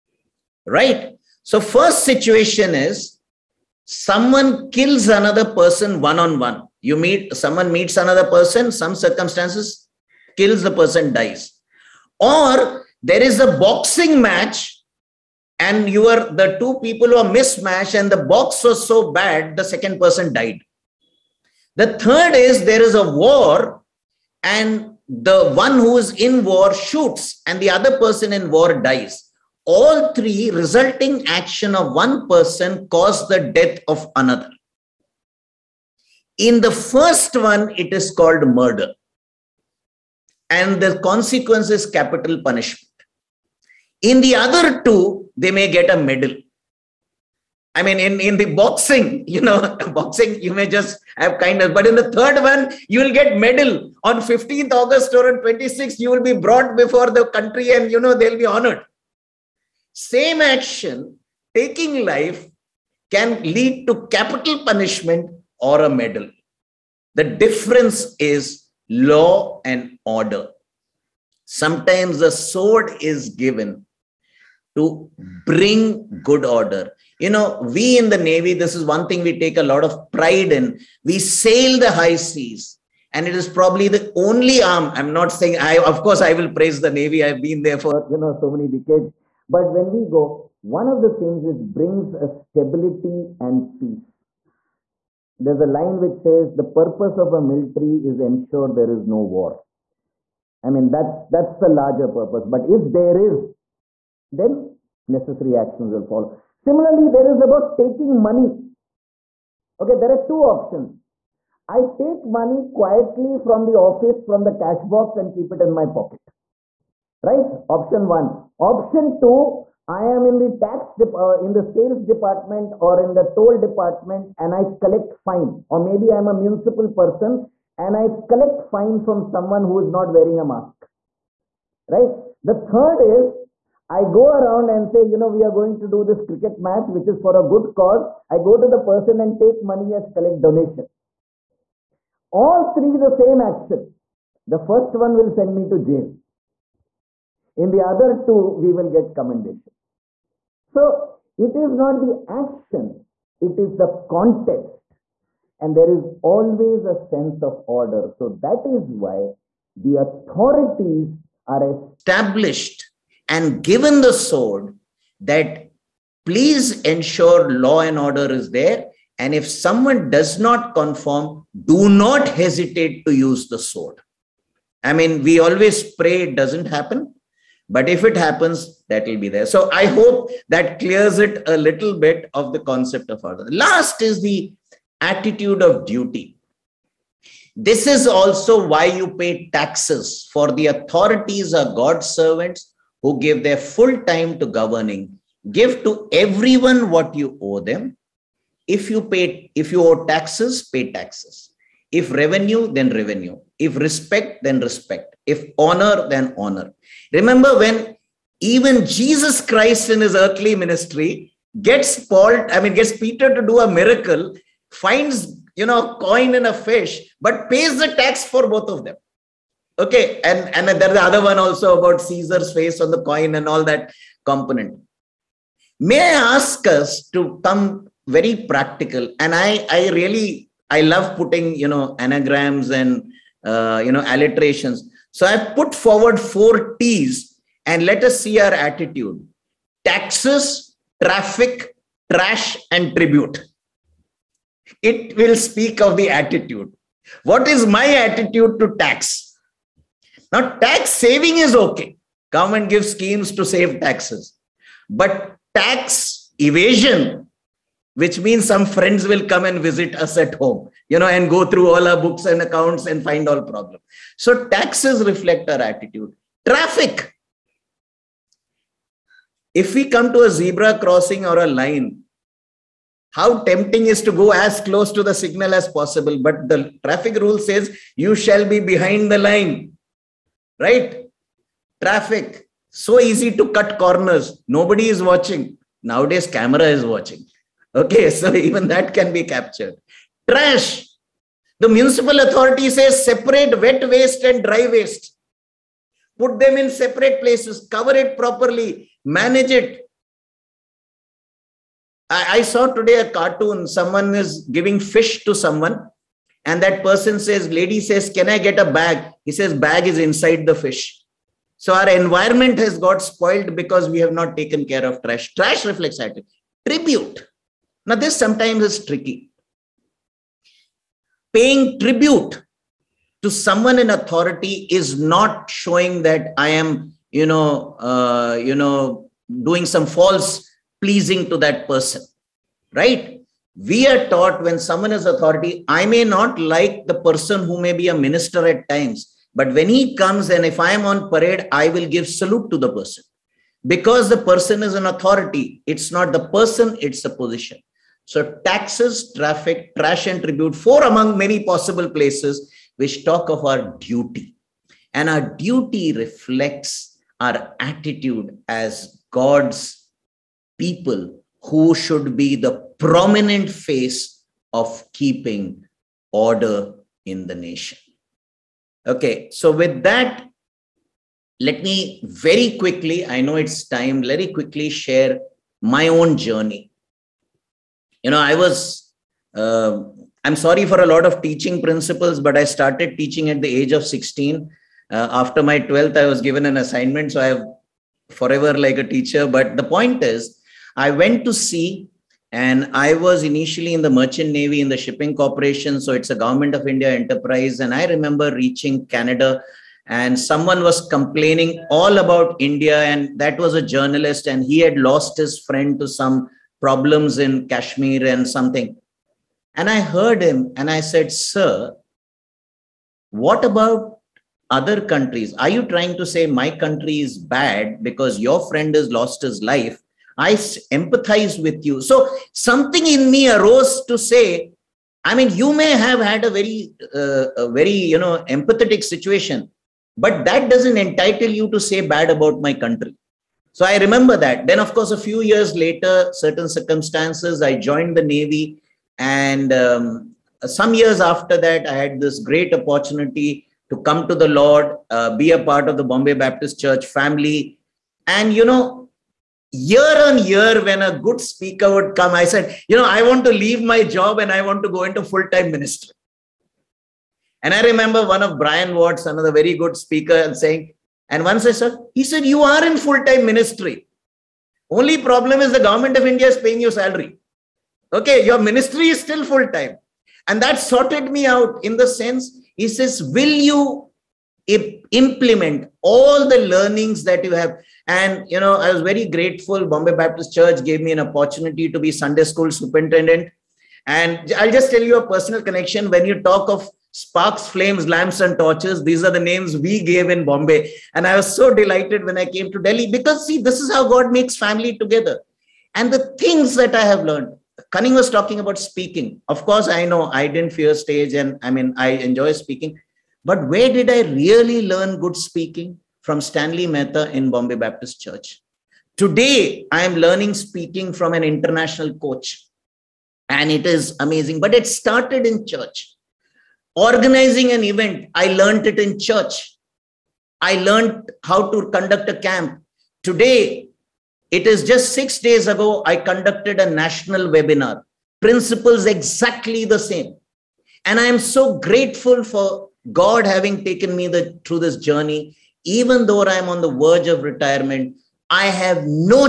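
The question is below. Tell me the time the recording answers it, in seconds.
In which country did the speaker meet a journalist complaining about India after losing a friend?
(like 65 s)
398 s.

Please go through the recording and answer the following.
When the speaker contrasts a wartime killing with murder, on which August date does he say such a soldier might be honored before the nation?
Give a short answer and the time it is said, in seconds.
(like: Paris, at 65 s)
15th August, at 54 s.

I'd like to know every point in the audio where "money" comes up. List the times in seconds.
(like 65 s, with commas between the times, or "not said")
108 s, 112 s, 139 s.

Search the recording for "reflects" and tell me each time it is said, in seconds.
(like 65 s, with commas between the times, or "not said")
265 s, 315 s, 355 s.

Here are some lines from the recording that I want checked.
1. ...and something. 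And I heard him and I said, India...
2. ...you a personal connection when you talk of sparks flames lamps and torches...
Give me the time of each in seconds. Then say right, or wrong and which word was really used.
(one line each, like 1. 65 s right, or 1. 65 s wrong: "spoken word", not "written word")
1. 408 s wrong: "Sir", not "India"
2. 484 s right.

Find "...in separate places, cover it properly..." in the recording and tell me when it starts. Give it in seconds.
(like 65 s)
296 s.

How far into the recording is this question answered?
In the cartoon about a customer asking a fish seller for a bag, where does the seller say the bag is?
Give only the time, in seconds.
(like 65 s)
309 s.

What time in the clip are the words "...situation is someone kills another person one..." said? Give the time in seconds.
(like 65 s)
2 s.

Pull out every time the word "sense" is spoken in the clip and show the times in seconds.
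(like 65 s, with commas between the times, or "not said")
156 s, 471 s.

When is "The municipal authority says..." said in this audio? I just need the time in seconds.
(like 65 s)
291 s.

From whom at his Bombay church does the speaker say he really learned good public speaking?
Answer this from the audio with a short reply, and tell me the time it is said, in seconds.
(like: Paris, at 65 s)
Stanley Mehta, at 506 s.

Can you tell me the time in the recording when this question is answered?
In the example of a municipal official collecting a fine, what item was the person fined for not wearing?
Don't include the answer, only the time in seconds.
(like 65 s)
130 s.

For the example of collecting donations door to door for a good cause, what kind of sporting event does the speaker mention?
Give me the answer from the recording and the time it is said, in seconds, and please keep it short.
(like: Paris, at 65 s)
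cricket match, at 136 s.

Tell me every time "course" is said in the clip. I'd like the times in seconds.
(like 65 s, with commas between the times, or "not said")
86 s, 434 s, 499 s.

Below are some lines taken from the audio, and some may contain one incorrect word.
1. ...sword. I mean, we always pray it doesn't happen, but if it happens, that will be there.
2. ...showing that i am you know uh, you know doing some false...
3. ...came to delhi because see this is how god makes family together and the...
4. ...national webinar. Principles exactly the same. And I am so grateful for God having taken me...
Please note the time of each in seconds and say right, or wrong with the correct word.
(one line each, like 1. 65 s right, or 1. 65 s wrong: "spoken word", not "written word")
1. 173 s right
2. 325 s right
3. 492 s right
4. 526 s right.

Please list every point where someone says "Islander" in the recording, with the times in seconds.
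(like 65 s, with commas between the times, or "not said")
not said.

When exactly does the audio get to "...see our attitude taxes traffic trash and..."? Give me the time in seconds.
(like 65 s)
238 s.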